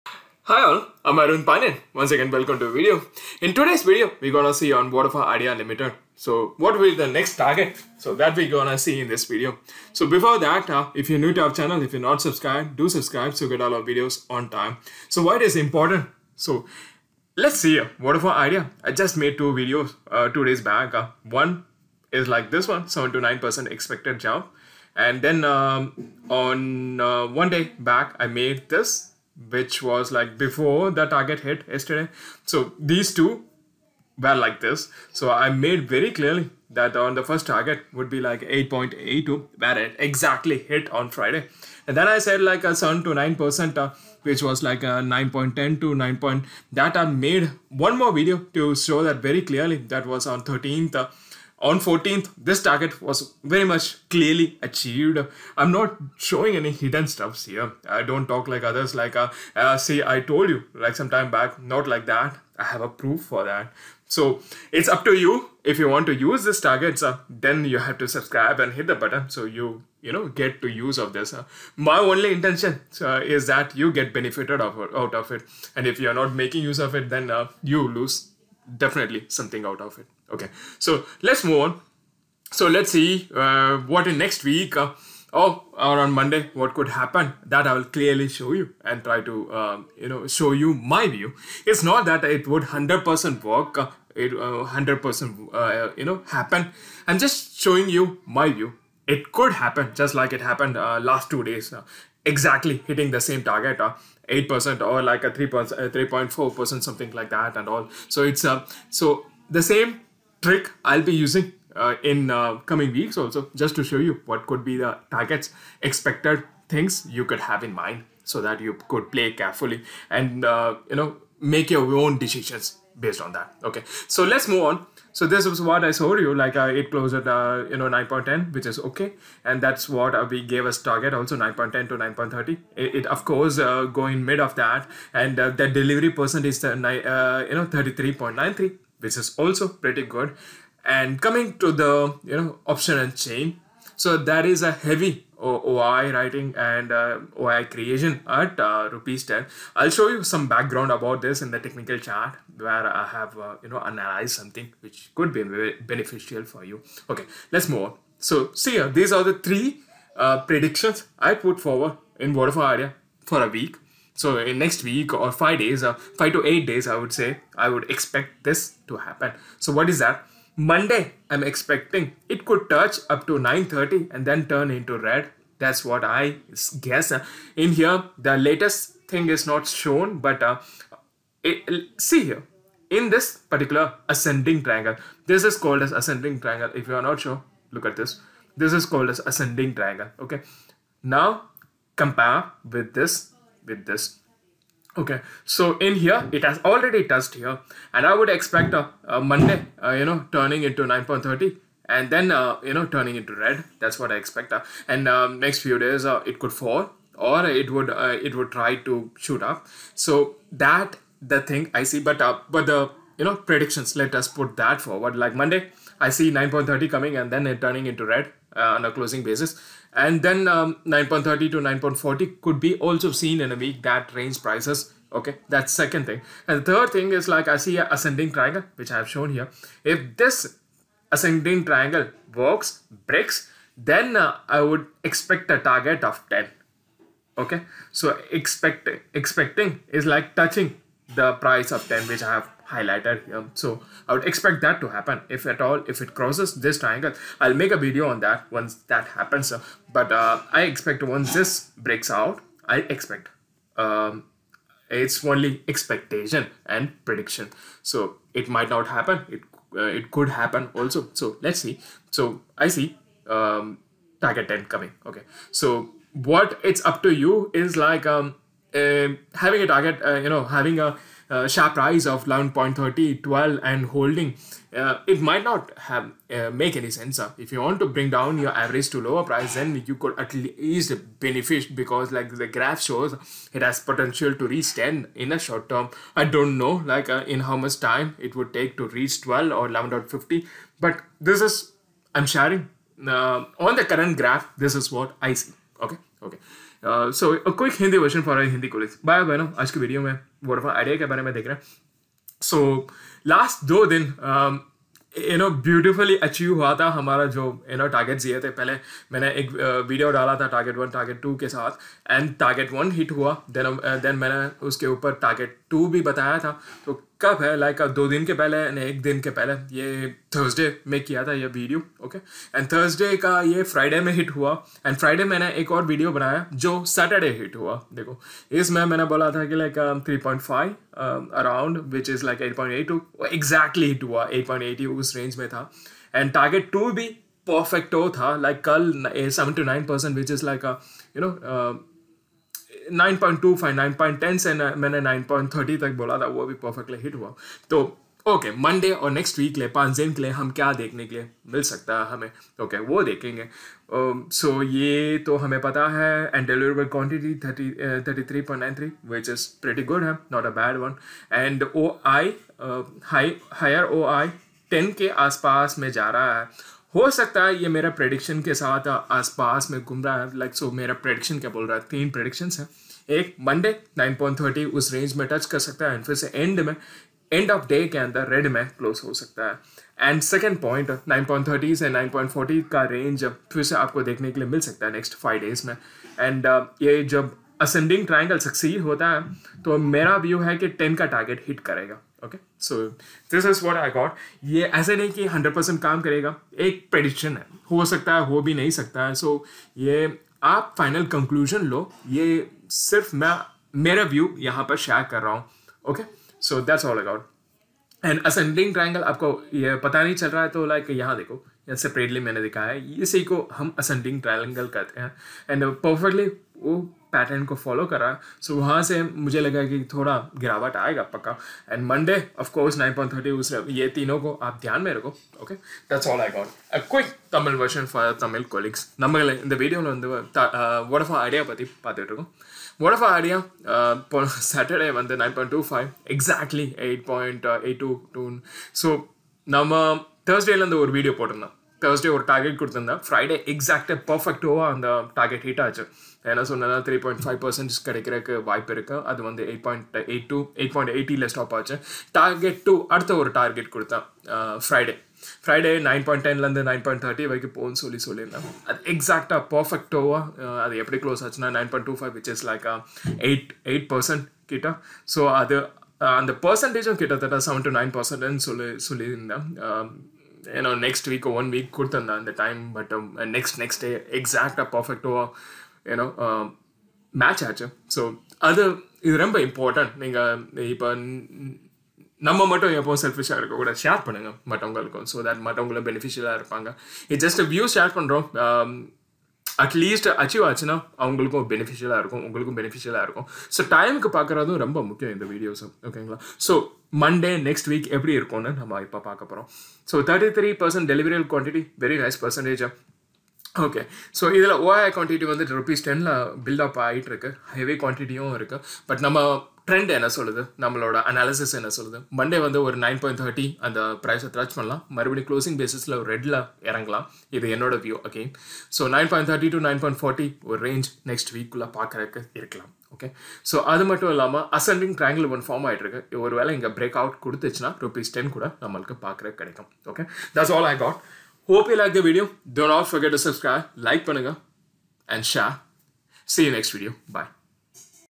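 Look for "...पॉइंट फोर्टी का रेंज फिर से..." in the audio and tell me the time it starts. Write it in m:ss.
6:22.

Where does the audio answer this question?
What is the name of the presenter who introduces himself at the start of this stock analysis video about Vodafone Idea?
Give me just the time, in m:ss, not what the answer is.
0:01.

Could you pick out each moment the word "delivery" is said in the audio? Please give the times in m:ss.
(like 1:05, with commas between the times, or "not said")
2:15.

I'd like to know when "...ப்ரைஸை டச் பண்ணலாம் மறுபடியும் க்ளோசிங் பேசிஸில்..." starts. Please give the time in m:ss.
8:34.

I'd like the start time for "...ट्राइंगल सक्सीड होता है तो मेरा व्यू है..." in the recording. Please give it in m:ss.
6:28.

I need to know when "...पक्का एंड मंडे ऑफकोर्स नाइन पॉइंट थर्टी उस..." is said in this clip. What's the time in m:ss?
7:01.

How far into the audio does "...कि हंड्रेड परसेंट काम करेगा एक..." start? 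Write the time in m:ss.
6:35.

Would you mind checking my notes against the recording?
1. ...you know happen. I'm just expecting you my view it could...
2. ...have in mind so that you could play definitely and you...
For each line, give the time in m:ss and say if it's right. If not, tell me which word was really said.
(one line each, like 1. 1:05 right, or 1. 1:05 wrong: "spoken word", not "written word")
1. 1:35 wrong: "showing", not "expecting"
2. 1:57 wrong: "carefully", not "definitely".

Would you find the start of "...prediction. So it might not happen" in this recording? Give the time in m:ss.
4:17.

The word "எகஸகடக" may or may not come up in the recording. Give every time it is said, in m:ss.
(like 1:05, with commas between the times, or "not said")
7:23, 7:38, 7:54.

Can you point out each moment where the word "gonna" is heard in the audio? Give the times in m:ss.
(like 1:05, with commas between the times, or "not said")
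0:04, 0:08.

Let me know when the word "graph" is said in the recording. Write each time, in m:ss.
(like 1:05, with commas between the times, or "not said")
4:42, 4:54.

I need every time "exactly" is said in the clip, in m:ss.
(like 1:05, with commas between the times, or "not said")
0:39, 1:42.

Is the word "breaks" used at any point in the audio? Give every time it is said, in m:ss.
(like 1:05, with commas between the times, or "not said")
3:53, 4:11.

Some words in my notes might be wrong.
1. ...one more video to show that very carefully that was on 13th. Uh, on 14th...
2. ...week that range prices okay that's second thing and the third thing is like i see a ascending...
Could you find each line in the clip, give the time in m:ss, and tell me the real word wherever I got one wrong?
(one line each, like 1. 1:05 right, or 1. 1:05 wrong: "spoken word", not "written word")
1. 0:47 wrong: "clearly", not "carefully"
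2. 3:43 right.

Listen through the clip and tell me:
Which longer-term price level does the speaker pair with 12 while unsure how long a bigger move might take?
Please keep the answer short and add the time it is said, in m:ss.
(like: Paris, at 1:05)
11.50, at 4:49.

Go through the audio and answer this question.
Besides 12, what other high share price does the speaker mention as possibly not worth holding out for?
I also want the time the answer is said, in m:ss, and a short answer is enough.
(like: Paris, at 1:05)
11.30, at 4:32.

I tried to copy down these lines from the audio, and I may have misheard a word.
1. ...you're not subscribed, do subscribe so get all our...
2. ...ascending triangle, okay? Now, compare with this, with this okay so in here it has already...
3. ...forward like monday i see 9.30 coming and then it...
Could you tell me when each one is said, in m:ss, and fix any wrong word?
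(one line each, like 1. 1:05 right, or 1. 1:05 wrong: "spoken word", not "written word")
1. 0:11 right
2. 3:09 right
3. 3:34 right.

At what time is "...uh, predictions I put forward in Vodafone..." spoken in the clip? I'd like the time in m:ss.
2:40.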